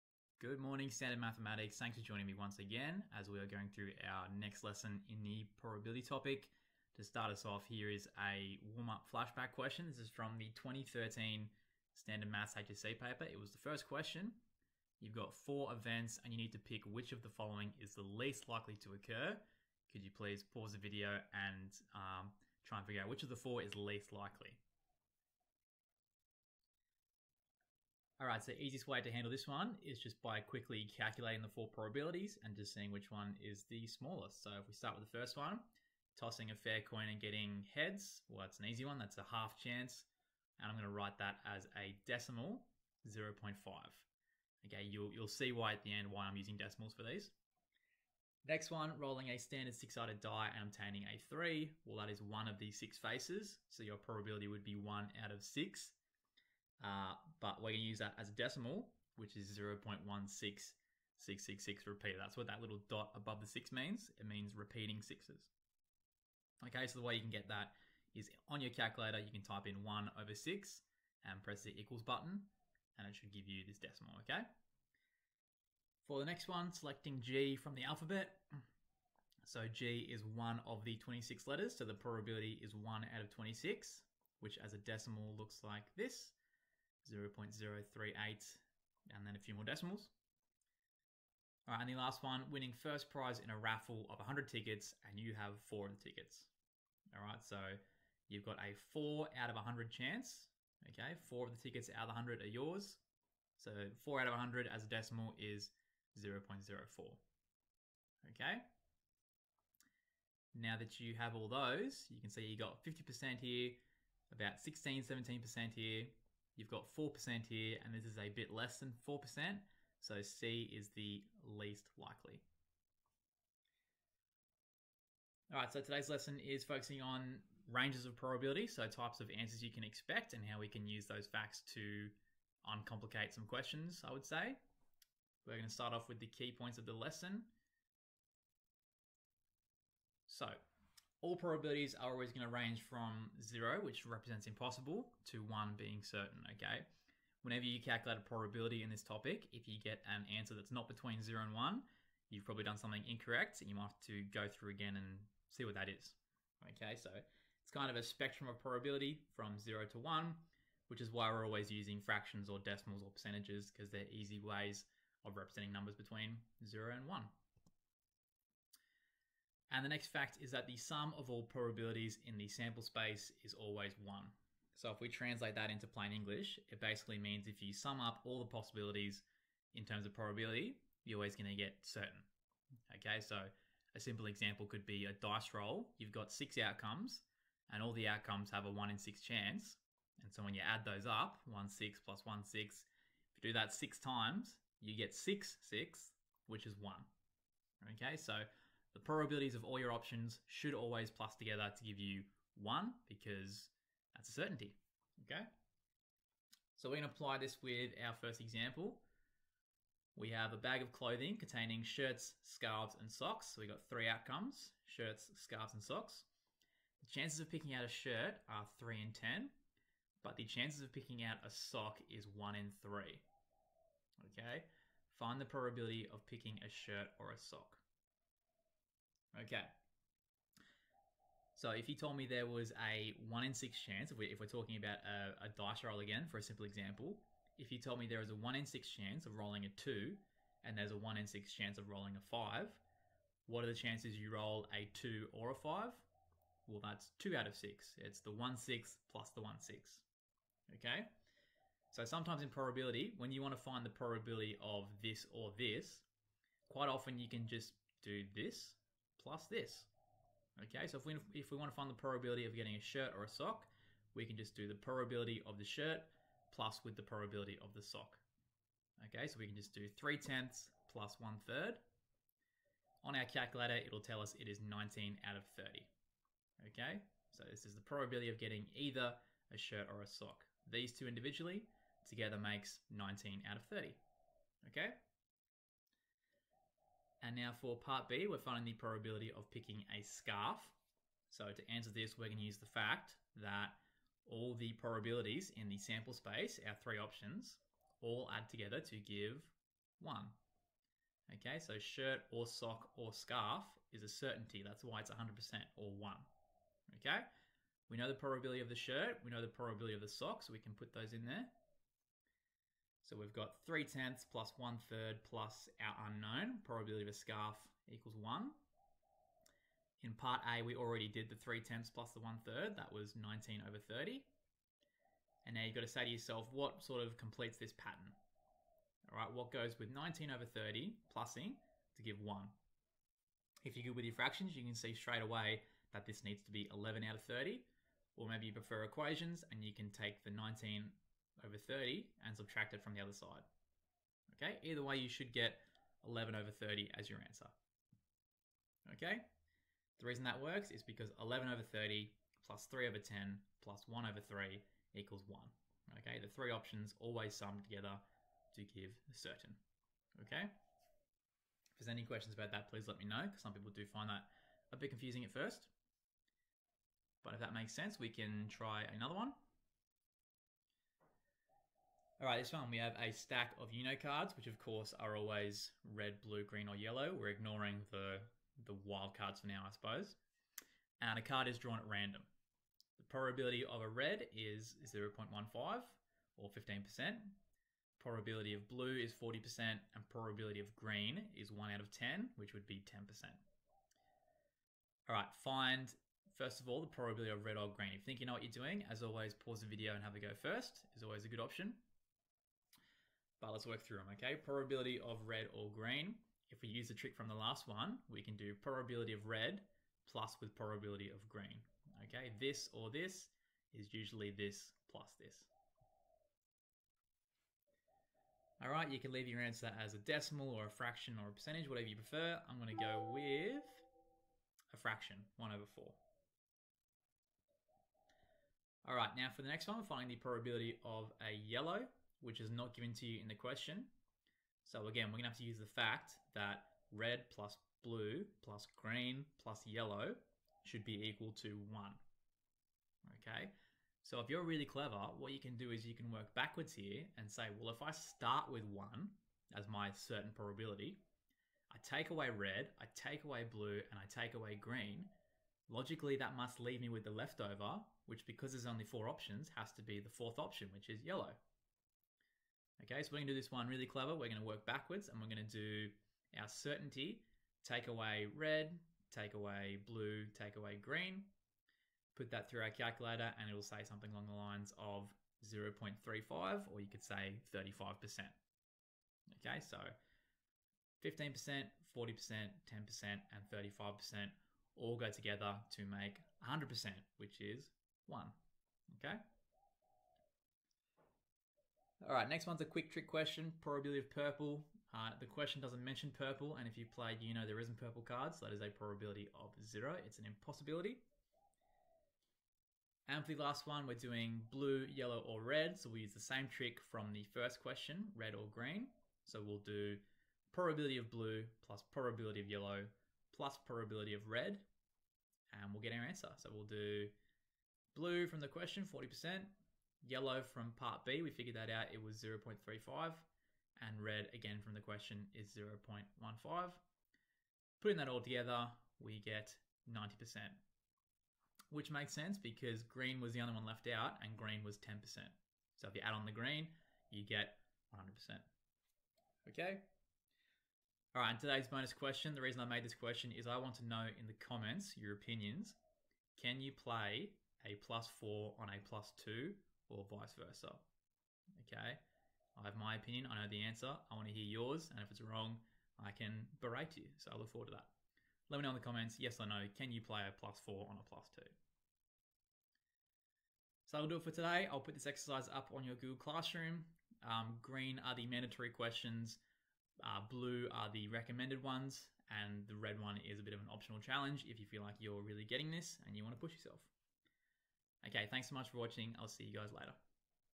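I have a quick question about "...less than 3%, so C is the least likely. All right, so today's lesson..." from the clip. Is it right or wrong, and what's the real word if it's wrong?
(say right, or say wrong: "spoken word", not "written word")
wrong: "4", not "3".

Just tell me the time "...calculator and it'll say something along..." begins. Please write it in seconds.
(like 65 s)
472 s.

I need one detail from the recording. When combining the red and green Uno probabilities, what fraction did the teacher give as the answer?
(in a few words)
1/4.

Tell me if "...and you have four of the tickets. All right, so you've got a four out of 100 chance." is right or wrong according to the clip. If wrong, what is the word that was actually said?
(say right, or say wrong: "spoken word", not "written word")
right.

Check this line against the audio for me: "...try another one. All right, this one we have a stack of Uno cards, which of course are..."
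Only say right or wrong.
right.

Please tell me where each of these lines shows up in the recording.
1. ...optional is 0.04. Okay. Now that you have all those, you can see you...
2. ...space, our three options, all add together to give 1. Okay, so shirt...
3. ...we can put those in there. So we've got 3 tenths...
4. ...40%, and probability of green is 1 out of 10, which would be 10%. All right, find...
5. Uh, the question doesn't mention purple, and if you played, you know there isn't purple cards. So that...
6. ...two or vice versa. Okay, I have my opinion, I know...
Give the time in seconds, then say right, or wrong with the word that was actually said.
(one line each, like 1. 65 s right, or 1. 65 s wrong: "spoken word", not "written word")
1. 104 s wrong: "decimal", not "optional"
2. 296 s right
3. 310 s right
4. 389 s right
5. 494 s right
6. 549 s right.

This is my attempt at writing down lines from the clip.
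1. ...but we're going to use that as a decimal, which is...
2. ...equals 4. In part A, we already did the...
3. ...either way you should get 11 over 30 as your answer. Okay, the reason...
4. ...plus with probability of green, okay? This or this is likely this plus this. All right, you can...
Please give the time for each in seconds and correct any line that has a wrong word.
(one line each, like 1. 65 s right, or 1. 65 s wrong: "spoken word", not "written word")
1. 57 s right
2. 317 s wrong: "1", not "4"
3. 344 s right
4. 410 s wrong: "usually", not "likely".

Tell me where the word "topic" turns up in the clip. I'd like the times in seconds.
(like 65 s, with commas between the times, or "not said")
6 s, 149 s.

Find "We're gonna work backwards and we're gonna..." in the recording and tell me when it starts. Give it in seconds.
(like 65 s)
464 s.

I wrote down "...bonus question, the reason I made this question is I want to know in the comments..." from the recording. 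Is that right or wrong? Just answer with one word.
right.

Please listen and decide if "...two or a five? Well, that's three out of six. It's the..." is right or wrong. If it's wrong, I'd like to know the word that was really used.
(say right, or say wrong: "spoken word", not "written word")
wrong: "two", not "three".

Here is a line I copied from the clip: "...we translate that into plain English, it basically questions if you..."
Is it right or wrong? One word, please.
wrong.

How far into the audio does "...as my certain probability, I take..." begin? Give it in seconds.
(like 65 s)
449 s.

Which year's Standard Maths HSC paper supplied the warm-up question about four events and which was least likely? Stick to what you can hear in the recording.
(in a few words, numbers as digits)
2013.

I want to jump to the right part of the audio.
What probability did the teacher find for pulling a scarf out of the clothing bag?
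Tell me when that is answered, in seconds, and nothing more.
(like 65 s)
336 s.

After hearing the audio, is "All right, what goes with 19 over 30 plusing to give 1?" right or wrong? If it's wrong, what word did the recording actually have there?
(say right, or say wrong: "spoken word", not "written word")
right.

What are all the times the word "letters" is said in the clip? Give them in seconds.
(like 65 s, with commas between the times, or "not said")
81 s.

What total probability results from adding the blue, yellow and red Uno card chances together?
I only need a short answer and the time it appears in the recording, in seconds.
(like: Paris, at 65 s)
90%, at 529 s.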